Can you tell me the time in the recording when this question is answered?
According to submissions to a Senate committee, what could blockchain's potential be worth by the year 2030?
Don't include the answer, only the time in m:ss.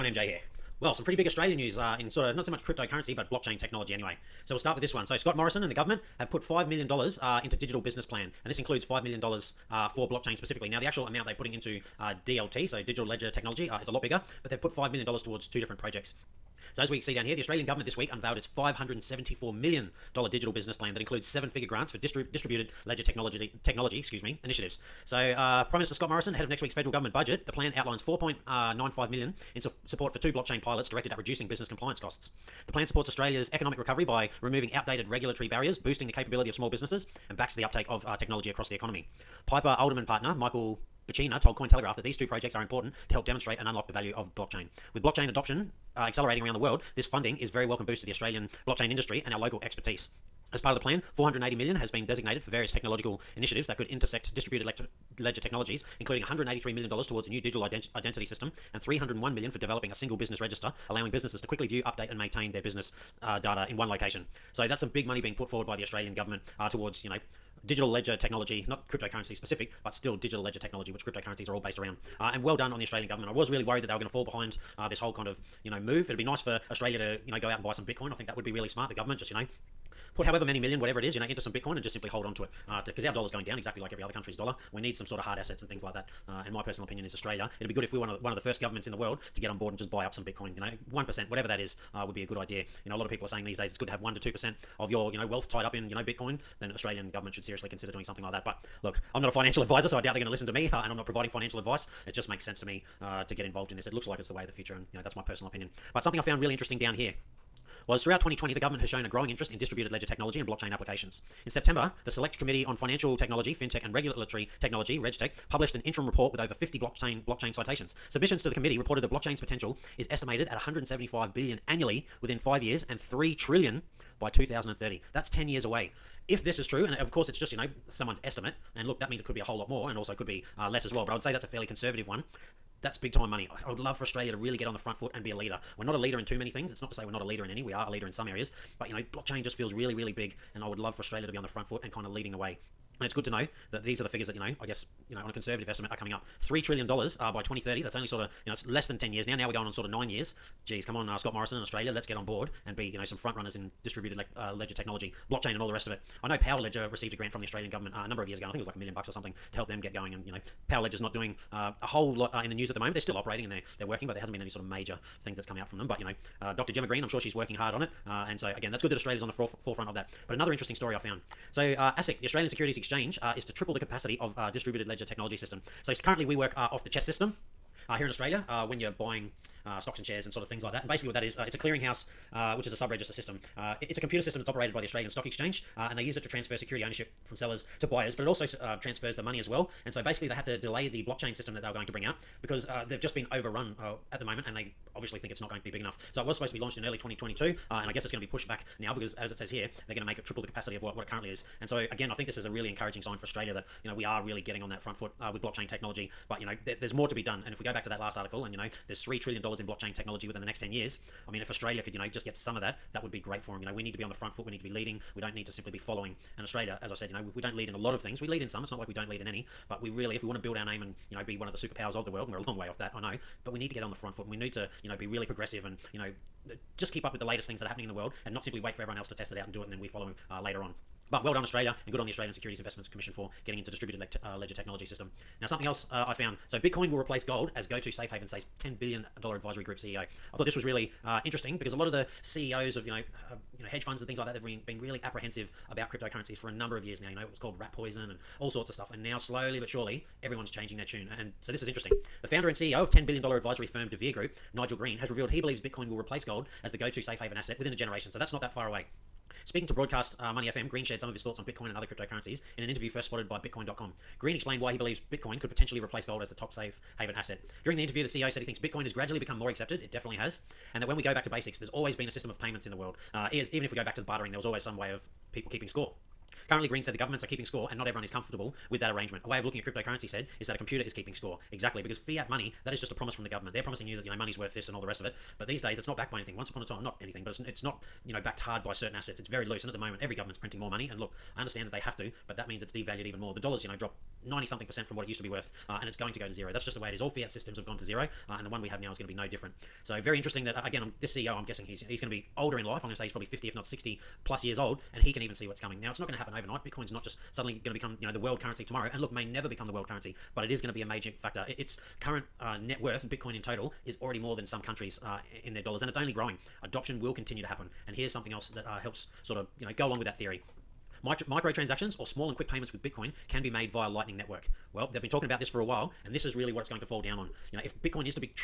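2:02.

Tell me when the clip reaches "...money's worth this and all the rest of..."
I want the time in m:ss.
4:44.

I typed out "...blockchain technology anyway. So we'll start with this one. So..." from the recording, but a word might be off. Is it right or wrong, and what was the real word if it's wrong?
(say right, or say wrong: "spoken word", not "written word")
right.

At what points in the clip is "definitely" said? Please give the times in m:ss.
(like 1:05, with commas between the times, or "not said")
4:29.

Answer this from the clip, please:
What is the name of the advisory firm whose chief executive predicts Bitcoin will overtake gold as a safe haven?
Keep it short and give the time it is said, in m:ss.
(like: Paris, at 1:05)
DeVere Group, at 4:13.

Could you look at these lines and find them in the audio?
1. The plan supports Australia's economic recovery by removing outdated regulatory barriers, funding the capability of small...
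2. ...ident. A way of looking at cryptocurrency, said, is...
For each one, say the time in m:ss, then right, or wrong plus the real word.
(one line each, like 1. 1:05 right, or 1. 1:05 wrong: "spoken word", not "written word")
1. 0:32 wrong: "boosting", not "funding"
2. 4:38 wrong: "arrangement", not "ident".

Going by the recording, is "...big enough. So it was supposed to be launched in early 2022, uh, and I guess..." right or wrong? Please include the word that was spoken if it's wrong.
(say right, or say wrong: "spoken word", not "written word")
right.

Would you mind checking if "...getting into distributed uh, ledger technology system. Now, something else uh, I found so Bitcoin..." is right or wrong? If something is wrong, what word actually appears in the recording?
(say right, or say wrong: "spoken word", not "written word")
right.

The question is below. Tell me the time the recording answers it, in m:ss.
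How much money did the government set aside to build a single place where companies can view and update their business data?
0:58.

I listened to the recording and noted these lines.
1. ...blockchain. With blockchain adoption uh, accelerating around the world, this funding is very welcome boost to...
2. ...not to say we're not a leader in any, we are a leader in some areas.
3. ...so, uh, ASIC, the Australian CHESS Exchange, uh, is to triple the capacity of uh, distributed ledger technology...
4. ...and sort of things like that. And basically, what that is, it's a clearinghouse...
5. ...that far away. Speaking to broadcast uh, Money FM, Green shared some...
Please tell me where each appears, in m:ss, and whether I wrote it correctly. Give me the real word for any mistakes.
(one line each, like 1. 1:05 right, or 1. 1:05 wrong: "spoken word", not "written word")
1. 0:44 right
2. 2:16 right
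3. 2:51 wrong: "Securities", not "CHESS"
4. 3:00 right
5. 4:18 right.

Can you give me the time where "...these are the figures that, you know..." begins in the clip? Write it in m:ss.
2:23.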